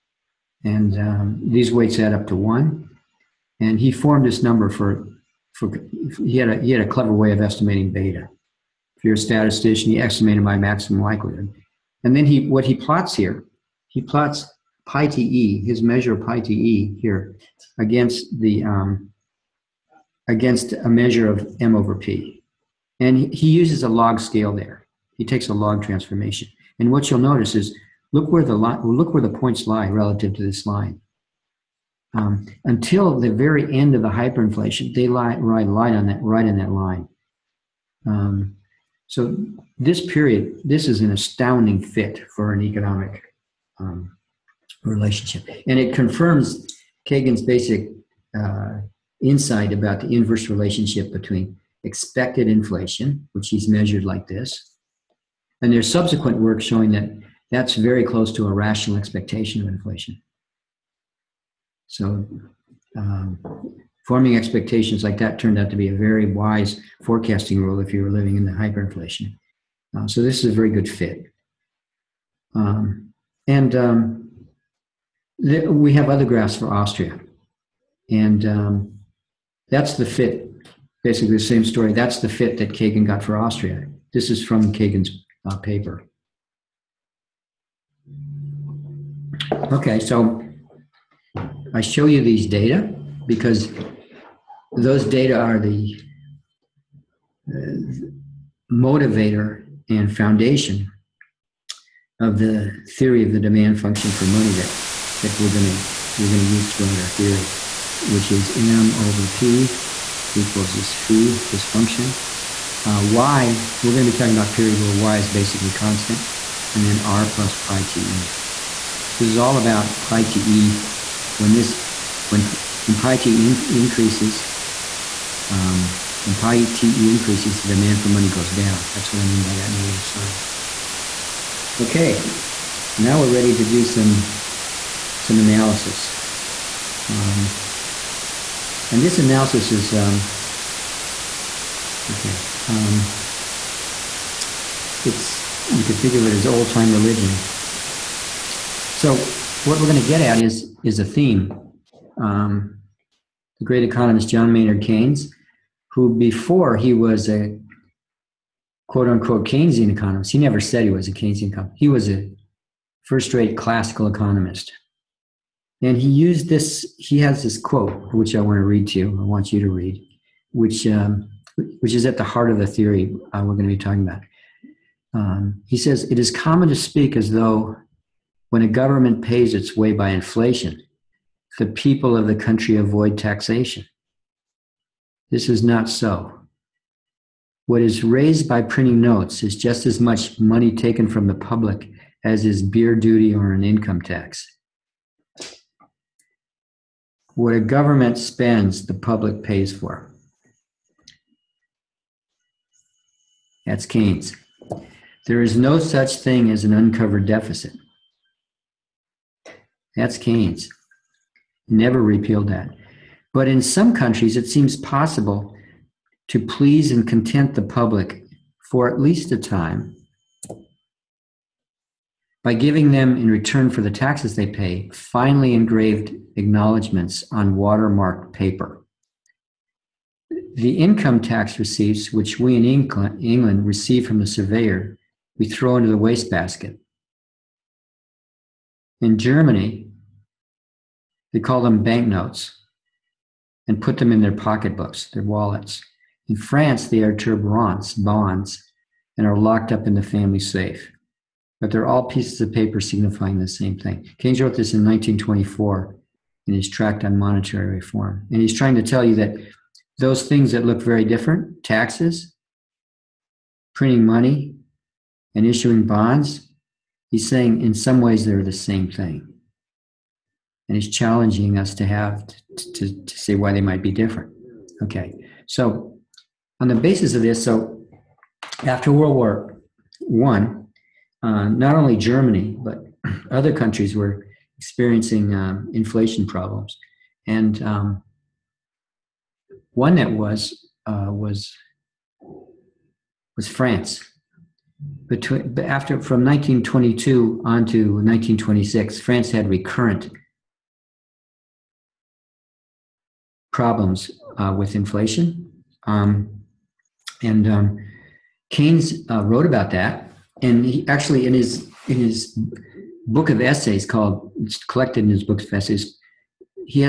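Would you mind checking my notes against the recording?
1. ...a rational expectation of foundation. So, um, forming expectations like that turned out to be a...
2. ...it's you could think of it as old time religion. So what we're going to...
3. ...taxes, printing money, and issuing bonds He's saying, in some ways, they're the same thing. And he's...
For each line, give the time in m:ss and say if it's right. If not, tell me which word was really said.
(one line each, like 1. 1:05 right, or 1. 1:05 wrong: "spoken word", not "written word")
1. 0:58 wrong: "inflation", not "foundation"
2. 2:25 right
3. 4:21 right.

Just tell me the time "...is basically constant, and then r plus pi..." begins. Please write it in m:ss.
1:55.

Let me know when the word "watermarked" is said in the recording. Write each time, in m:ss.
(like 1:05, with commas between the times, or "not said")
3:47.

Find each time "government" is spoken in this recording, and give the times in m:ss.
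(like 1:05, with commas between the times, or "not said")
2:58, 3:17.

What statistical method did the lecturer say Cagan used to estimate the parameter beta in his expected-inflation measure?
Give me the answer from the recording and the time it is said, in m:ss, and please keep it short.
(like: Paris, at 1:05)
Maximum likelihood, at 0:10.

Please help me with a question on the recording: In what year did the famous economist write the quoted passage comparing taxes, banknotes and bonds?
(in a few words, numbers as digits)
1924.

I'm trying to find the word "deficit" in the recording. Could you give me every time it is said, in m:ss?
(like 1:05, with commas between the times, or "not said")
3:27.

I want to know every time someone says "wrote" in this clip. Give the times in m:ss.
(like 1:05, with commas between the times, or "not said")
4:14, 5:09.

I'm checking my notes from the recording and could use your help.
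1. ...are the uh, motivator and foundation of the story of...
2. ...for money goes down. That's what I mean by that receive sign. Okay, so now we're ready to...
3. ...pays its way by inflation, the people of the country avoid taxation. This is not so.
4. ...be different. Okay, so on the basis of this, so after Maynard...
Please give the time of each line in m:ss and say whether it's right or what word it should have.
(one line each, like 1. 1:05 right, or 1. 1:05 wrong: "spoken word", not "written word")
1. 1:35 wrong: "theory", not "story"
2. 2:08 wrong: "negative", not "receive"
3. 2:59 right
4. 4:33 wrong: "World", not "Maynard".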